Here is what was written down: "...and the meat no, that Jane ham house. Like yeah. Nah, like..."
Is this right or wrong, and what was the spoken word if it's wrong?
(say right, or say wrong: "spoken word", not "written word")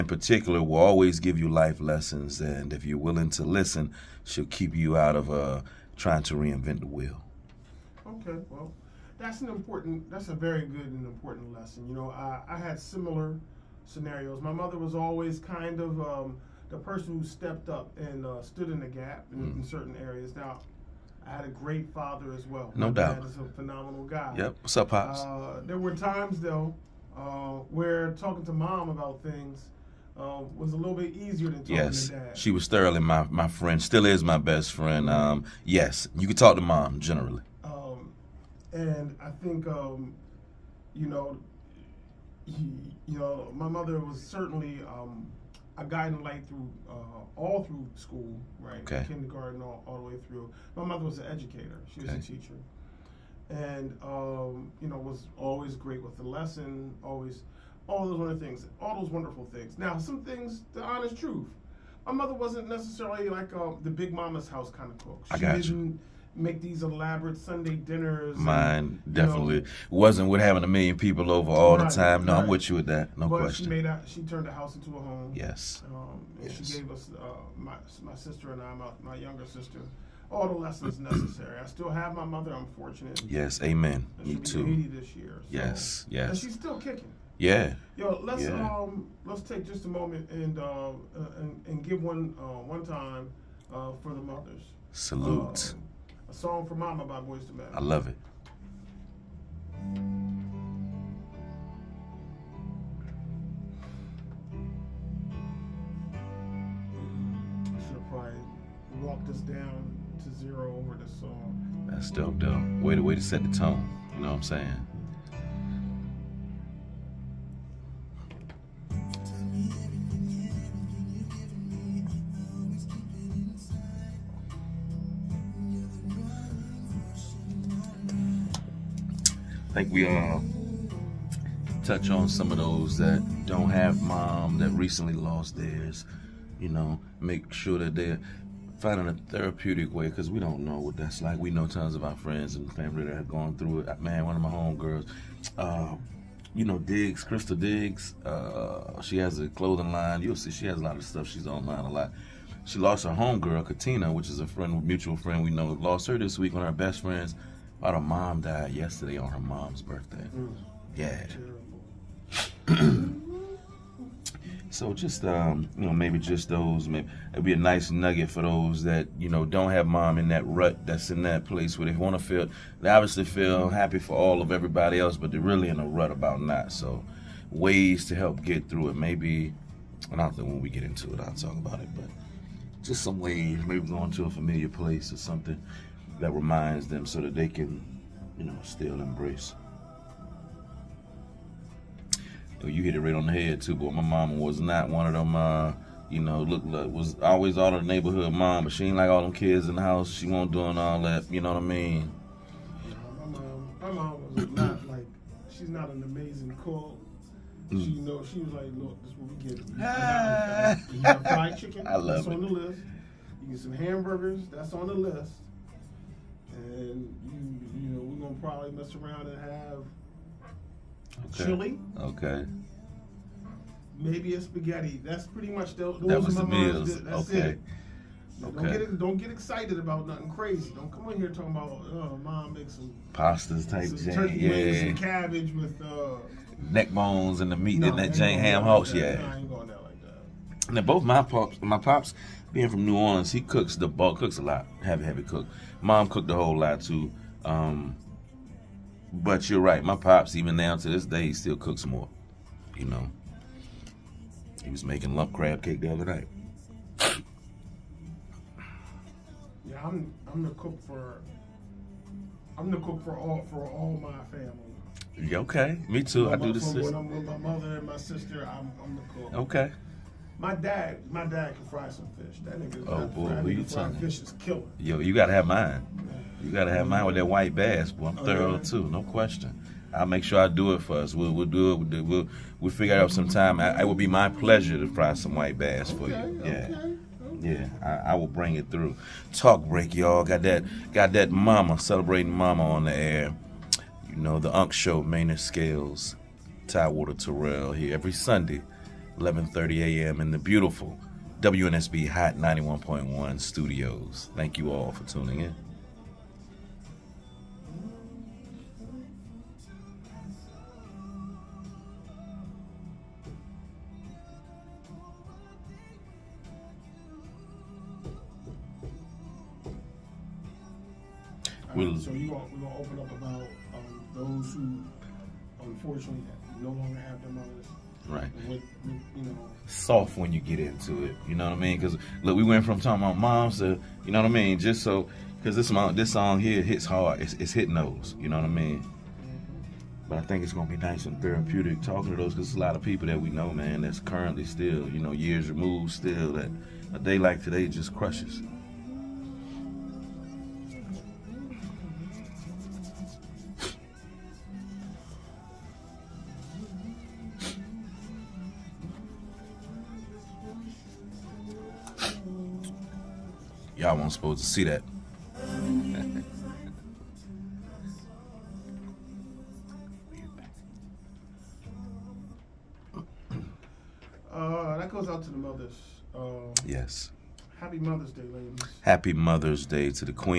right.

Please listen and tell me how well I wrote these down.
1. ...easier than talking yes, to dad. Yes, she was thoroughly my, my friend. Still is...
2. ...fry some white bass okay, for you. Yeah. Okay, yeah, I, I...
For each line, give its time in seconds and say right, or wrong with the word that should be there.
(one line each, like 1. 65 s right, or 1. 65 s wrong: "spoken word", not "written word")
1. 31 s right
2. 284 s right.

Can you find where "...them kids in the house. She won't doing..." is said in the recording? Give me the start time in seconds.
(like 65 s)
199 s.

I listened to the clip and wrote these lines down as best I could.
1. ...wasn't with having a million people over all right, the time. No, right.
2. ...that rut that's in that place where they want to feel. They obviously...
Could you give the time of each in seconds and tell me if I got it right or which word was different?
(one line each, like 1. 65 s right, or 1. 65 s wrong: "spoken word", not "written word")
1. 69 s right
2. 170 s right.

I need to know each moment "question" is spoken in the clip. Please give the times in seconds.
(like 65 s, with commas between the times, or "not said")
73 s, 279 s.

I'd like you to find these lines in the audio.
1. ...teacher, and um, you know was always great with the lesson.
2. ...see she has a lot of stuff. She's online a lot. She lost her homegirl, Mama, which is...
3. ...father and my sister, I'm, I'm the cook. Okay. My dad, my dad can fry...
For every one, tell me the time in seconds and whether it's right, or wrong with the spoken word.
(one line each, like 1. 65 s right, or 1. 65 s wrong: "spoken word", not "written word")
1. 52 s right
2. 150 s wrong: "Katina", not "Mama"
3. 267 s wrong: "mother", not "father".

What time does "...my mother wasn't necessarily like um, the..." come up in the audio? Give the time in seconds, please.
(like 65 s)
62 s.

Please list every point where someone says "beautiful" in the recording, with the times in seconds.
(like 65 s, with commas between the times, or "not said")
300 s.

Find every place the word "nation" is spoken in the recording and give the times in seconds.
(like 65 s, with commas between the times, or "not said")
not said.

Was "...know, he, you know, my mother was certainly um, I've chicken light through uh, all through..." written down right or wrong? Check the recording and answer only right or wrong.
wrong.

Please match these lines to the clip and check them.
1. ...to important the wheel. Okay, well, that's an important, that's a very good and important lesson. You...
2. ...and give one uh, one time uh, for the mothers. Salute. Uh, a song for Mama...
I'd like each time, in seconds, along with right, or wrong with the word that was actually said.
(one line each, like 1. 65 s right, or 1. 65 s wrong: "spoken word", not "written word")
1. 6 s wrong: "reinvent", not "important"
2. 91 s right.